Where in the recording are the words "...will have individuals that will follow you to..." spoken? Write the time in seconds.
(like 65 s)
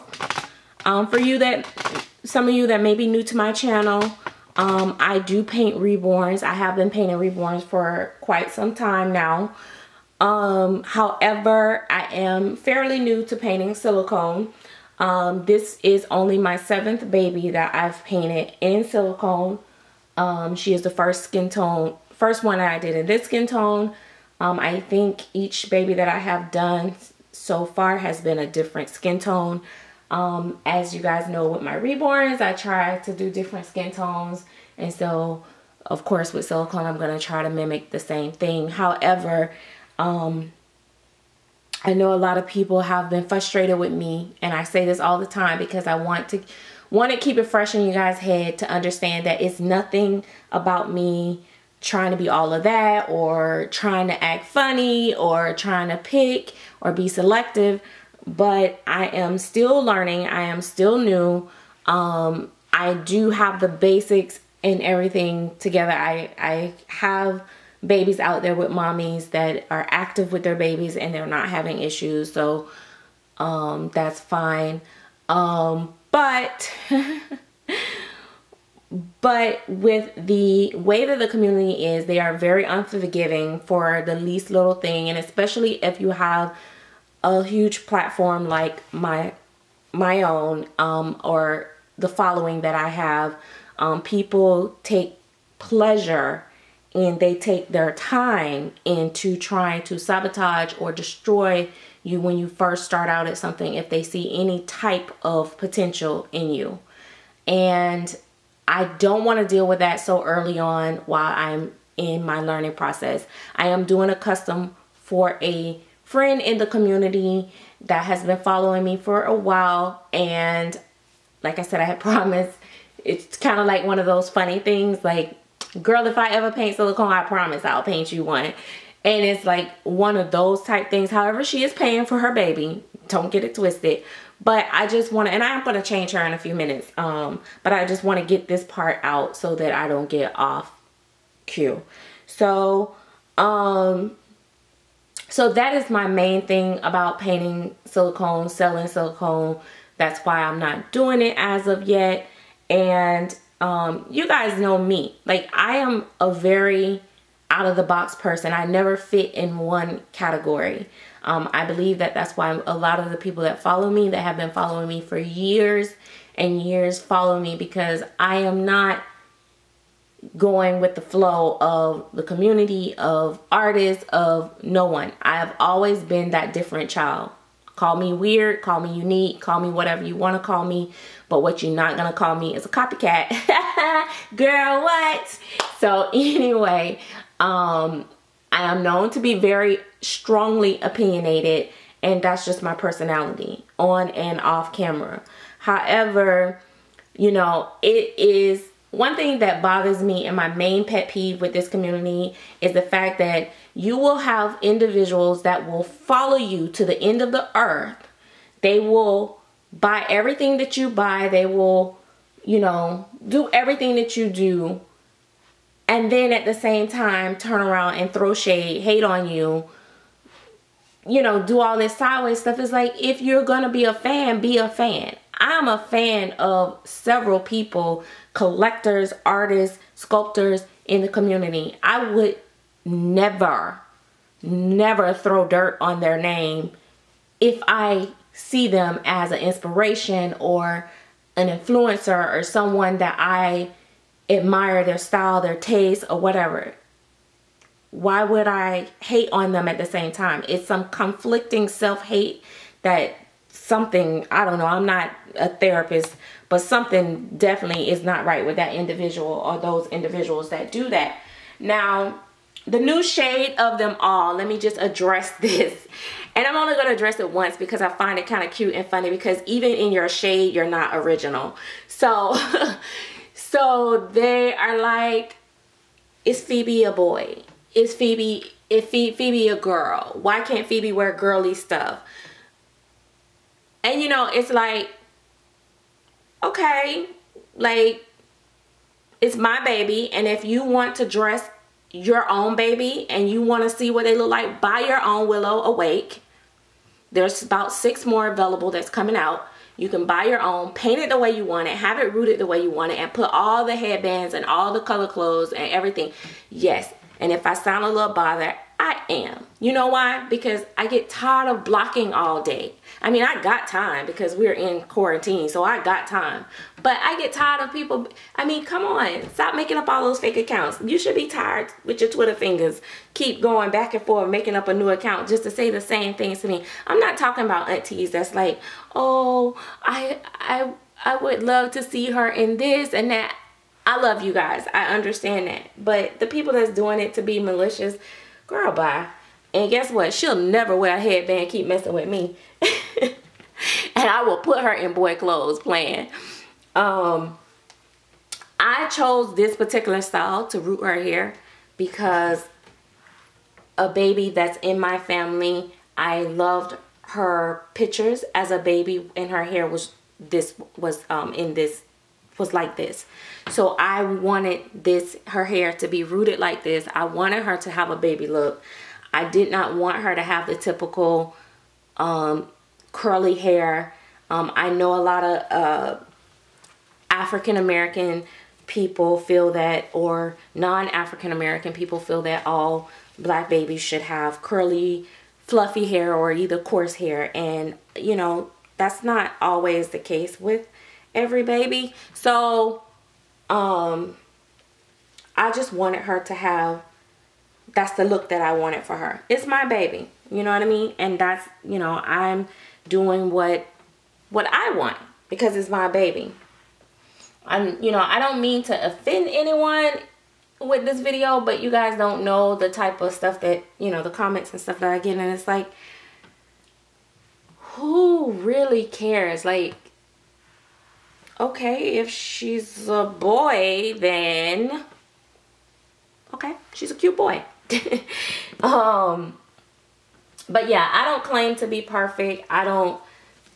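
203 s.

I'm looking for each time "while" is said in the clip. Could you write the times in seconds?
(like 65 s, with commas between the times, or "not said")
110 s, 119 s.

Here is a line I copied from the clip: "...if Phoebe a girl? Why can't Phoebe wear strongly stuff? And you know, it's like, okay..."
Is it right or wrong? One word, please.
wrong.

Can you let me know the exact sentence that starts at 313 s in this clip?
I mean, I got time because we're in quarantine, so I got time.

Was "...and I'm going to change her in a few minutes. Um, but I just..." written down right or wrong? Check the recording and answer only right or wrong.
right.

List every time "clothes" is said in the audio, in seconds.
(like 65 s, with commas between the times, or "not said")
305 s, 345 s.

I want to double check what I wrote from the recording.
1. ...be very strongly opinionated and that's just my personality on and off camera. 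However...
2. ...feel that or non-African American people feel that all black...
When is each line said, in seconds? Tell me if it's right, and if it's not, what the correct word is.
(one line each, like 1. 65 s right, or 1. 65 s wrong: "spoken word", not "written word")
1. 189 s right
2. 379 s right.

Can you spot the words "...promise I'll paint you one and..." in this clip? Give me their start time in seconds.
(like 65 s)
127 s.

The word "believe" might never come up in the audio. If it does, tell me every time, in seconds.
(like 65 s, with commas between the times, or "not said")
161 s.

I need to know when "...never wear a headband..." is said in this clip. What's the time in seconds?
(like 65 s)
340 s.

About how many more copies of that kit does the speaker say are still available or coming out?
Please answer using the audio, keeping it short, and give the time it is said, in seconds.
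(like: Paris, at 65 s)
6, at 297 s.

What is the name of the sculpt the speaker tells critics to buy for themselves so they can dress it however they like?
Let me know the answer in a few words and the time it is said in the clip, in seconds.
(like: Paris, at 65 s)
Willow Awake, at 295 s.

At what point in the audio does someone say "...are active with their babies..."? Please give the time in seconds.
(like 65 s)
69 s.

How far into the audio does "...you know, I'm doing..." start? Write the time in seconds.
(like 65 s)
401 s.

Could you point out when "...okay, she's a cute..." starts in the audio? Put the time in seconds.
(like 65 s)
426 s.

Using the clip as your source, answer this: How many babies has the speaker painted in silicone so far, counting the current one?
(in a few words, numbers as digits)
7.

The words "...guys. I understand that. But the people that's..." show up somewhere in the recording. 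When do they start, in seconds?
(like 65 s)
334 s.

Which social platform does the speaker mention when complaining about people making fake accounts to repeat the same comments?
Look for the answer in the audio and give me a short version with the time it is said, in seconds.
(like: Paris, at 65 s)
Twitter, at 322 s.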